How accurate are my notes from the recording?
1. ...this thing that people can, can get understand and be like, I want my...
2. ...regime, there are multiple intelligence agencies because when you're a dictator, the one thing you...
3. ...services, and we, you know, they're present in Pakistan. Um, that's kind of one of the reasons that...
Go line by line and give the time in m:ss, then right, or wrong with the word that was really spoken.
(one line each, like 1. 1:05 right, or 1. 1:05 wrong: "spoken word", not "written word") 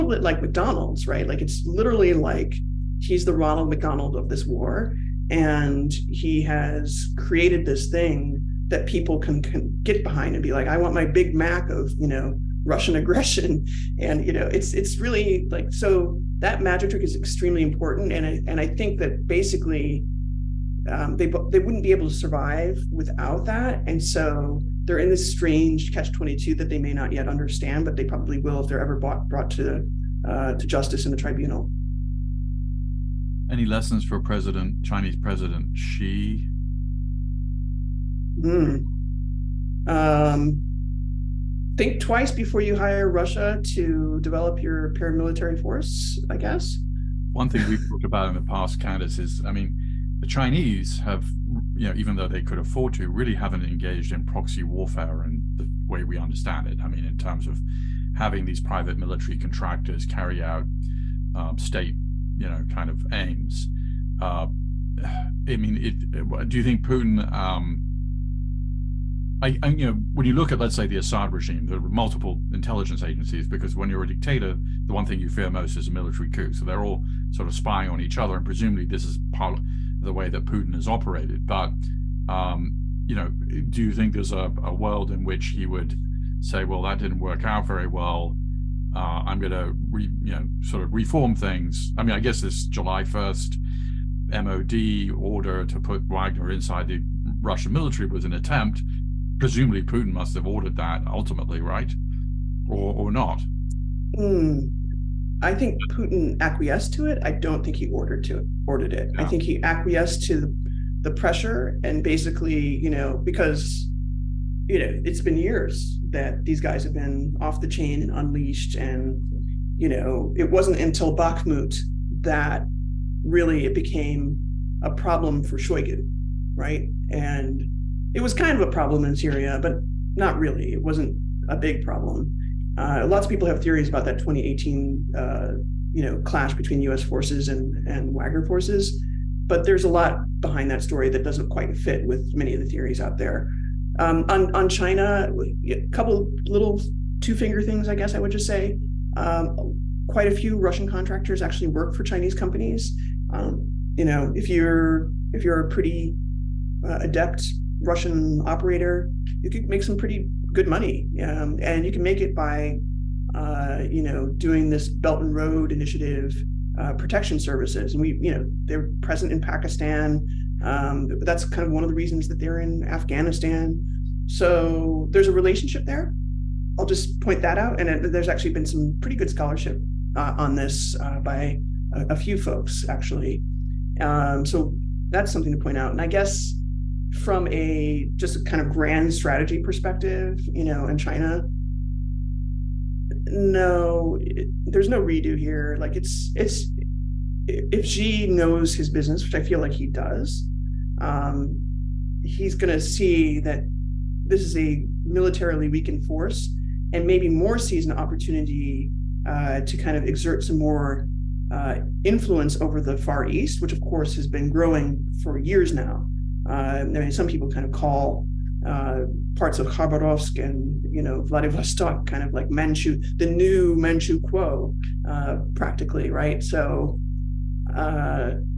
1. 0:07 wrong: "behind", not "understand"
2. 1:11 right
3. 2:47 right.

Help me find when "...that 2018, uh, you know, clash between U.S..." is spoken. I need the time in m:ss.
2:14.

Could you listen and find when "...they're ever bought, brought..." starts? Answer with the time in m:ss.
0:28.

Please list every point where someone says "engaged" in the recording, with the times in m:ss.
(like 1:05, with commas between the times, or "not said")
0:53.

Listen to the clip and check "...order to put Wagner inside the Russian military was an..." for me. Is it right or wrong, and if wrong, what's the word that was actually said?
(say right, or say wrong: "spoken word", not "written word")
right.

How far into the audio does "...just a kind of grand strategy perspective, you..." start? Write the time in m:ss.
3:08.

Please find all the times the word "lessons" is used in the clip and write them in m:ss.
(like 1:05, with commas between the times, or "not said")
0:33.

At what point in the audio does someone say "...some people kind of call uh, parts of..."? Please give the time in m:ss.
3:37.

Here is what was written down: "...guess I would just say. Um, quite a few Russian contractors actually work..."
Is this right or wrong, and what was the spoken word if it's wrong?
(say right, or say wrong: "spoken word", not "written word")
right.